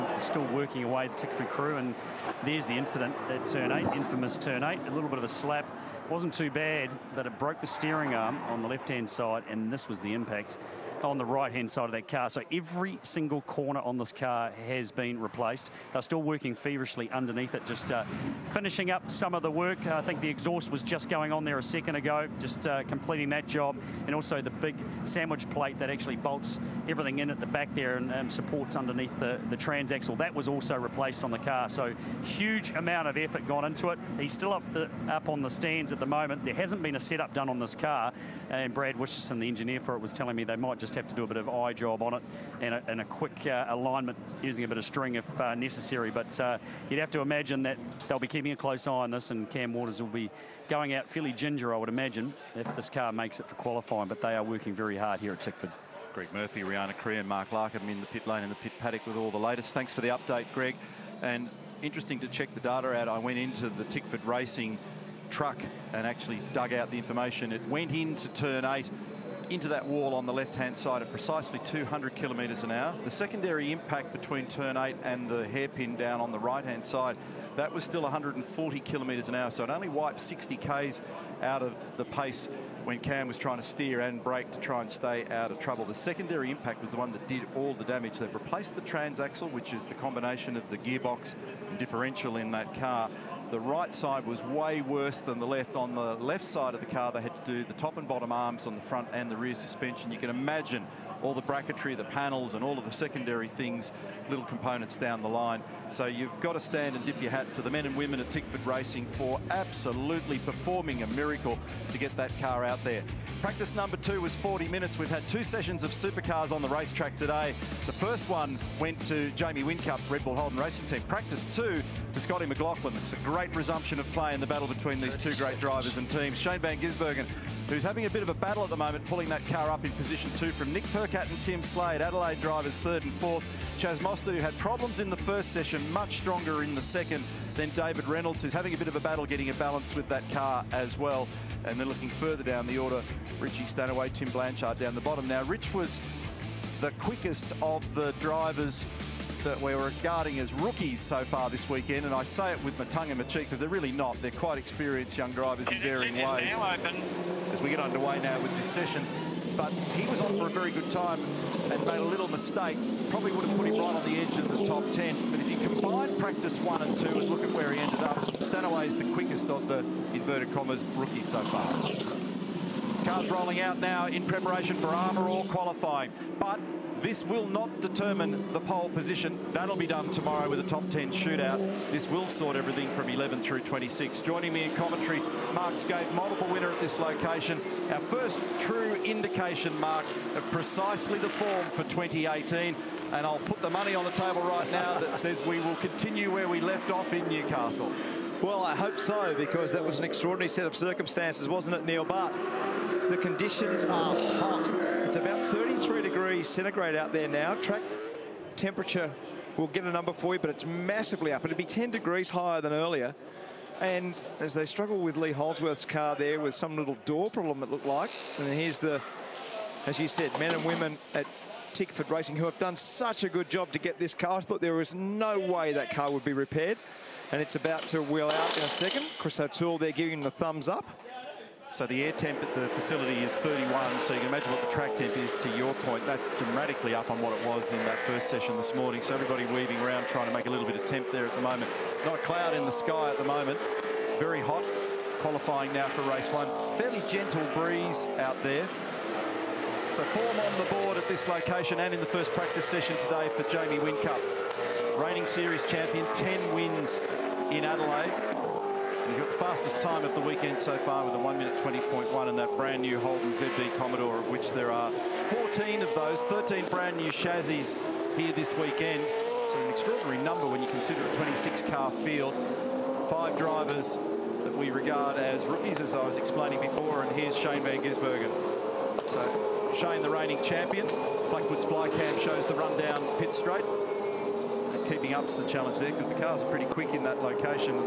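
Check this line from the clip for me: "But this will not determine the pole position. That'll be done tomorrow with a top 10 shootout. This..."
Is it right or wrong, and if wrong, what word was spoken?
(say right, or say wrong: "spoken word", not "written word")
right.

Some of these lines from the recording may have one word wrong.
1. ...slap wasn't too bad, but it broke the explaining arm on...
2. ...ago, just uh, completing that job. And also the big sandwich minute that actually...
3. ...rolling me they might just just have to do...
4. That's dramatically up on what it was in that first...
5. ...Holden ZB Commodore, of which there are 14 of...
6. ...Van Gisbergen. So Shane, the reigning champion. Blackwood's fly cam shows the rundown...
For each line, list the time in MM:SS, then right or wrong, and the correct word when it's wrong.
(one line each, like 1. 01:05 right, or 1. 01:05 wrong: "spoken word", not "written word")
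1. 00:05 wrong: "steering", not "explaining"
2. 00:21 wrong: "plate", not "minute"
3. 00:40 wrong: "telling", not "rolling"
4. 03:56 right
5. 04:22 right
6. 04:37 right.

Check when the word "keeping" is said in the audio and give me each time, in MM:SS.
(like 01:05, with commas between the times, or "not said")
00:48, 04:44.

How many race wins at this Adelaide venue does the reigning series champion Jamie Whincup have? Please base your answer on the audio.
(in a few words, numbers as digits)
10.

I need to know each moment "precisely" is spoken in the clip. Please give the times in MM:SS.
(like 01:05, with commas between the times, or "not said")
01:11, 03:10.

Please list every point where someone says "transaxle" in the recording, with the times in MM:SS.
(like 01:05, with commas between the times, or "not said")
00:29, 01:28.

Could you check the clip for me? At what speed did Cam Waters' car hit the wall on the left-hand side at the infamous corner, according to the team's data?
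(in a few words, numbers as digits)
200 km/h.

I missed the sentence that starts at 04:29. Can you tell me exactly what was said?
It's an extraordinary number when you consider a 26-car field.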